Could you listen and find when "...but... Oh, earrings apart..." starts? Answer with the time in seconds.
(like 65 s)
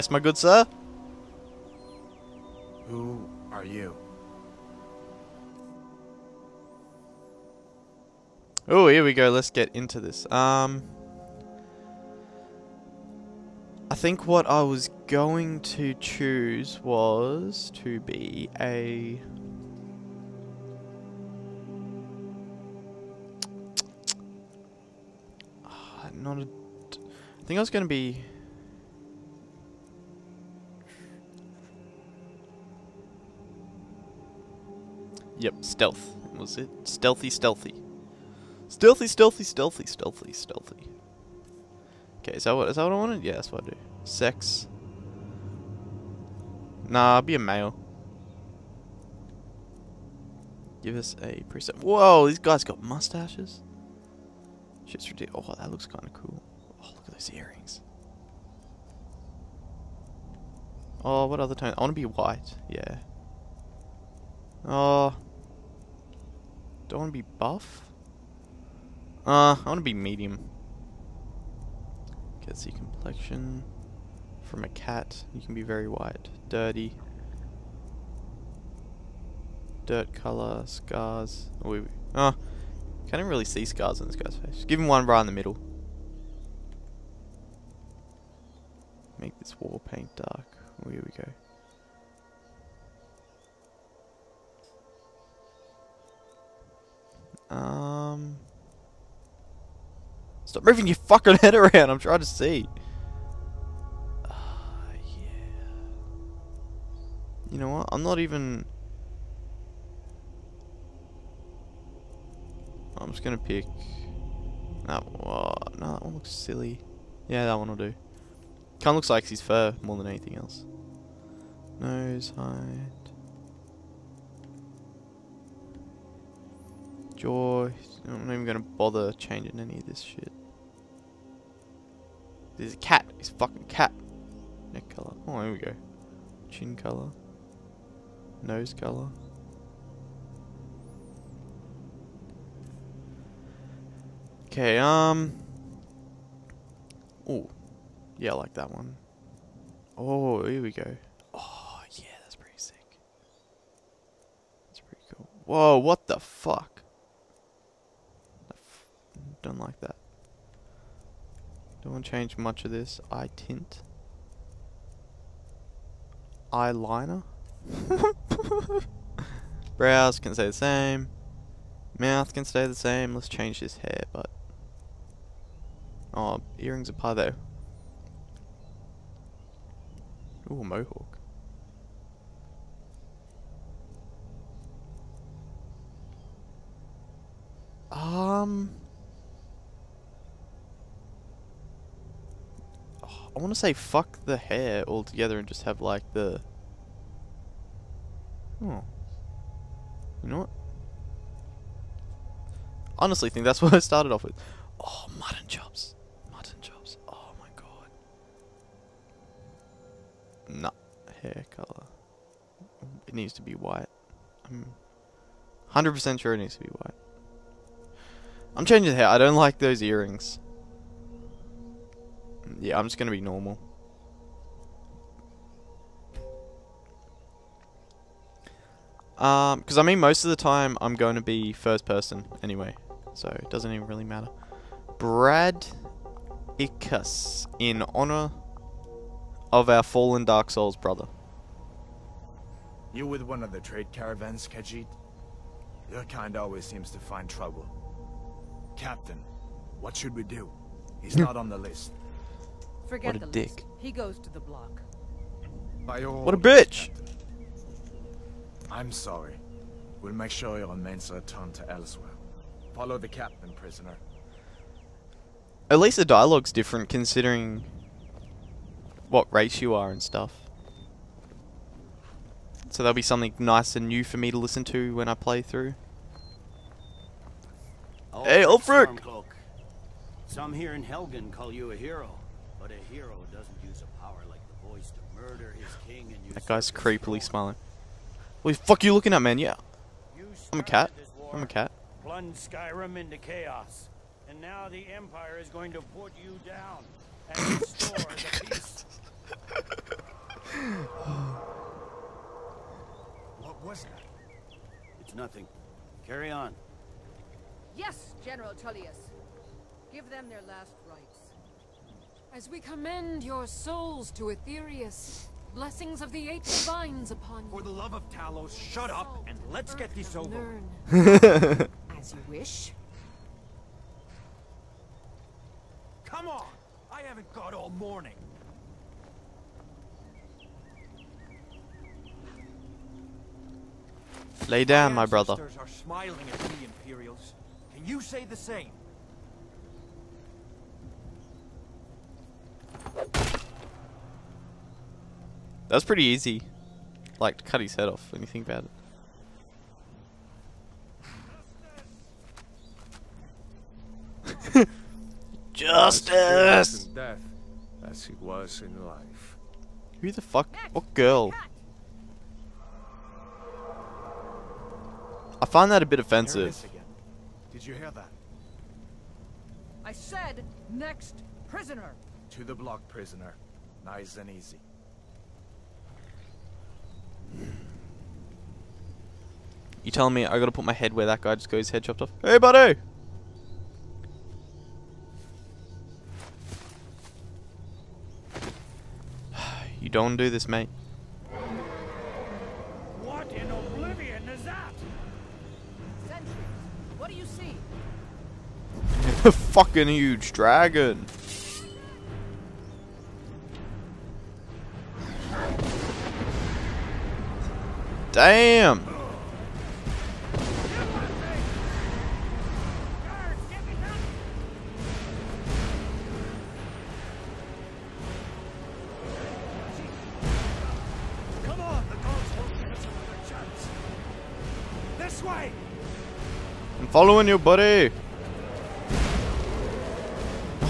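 174 s.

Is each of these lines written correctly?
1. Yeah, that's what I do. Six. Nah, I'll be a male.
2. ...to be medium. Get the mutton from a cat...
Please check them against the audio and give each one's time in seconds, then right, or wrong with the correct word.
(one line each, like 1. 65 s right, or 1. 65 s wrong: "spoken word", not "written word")
1. 43 s right
2. 69 s wrong: "complexion", not "mutton".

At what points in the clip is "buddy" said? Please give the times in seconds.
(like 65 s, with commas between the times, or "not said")
382 s, 427 s.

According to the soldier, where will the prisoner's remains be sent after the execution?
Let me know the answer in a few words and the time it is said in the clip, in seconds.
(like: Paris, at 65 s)
Elsweyr, at 261 s.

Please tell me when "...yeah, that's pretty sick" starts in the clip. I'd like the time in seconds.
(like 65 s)
151 s.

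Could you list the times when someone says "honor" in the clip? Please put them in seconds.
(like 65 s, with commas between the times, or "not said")
237 s.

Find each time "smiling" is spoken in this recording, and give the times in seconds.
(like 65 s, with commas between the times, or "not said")
287 s, 335 s.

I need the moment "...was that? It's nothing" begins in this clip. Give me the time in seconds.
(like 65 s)
303 s.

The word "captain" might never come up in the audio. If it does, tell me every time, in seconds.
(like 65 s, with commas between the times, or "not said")
248 s, 256 s, 263 s.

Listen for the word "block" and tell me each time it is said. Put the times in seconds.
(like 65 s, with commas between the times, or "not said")
254 s, 372 s.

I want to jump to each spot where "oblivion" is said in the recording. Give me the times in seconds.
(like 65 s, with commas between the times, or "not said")
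393 s.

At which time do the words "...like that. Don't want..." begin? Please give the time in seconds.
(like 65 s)
159 s.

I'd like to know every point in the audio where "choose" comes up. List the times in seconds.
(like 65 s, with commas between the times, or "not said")
15 s.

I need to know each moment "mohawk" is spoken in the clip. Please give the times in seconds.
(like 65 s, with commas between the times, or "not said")
180 s.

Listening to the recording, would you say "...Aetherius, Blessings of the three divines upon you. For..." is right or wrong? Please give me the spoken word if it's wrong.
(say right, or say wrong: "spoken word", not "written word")
wrong: "eight", not "three".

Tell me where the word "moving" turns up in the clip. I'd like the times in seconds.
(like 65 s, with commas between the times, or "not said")
100 s.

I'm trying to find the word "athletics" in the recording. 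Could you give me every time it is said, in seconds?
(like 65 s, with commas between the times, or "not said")
not said.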